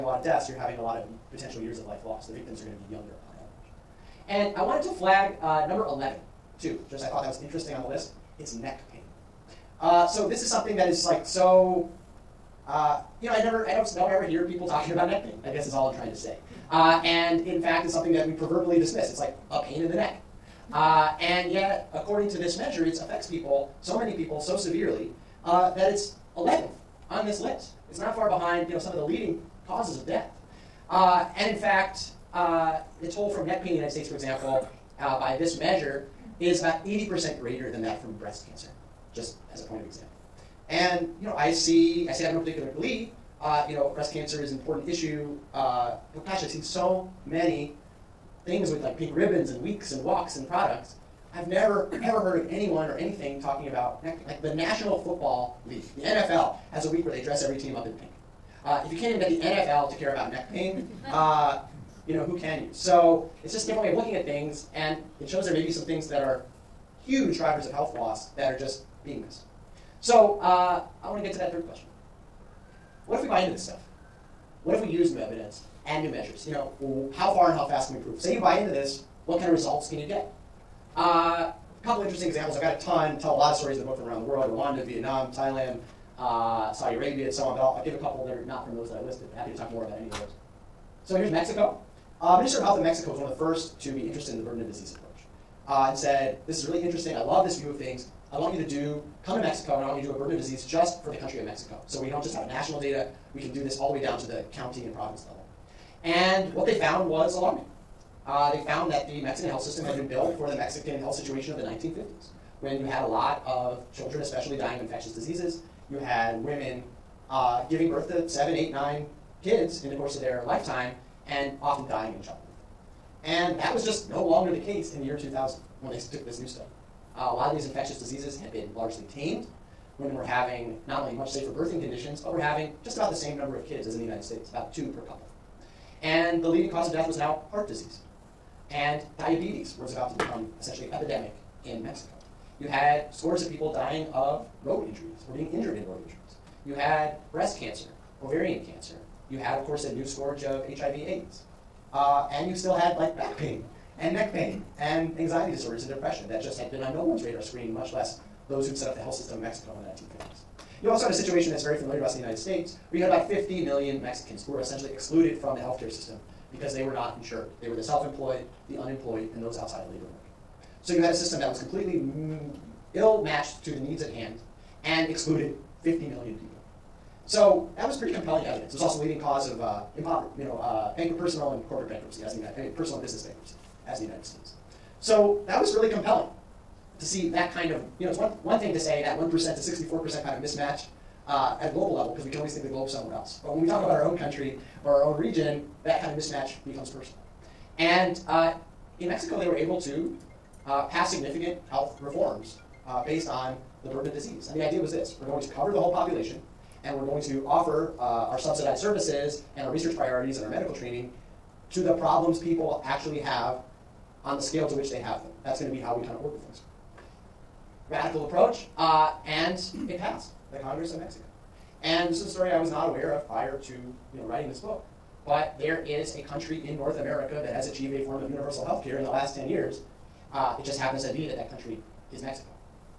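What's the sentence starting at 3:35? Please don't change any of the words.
That's going to be how we kind of work with things.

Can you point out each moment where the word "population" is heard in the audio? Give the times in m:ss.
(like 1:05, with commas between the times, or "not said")
3:25.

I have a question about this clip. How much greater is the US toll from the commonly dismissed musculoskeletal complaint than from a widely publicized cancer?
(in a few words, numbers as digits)
80%.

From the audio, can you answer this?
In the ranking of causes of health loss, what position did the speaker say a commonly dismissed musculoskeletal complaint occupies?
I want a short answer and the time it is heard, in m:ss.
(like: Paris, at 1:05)
11th, at 0:26.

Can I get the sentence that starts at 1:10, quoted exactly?
So uh, I want to get to that third question.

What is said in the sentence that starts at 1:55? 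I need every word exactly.
You had women uh, giving birth to seven, eight, nine kids in the course of their lifetime and often dying in childbirth.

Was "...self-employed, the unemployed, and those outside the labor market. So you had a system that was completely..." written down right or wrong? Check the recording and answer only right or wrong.
right.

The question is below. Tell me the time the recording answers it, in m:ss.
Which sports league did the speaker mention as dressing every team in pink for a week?
0:54.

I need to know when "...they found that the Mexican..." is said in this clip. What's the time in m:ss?
1:48.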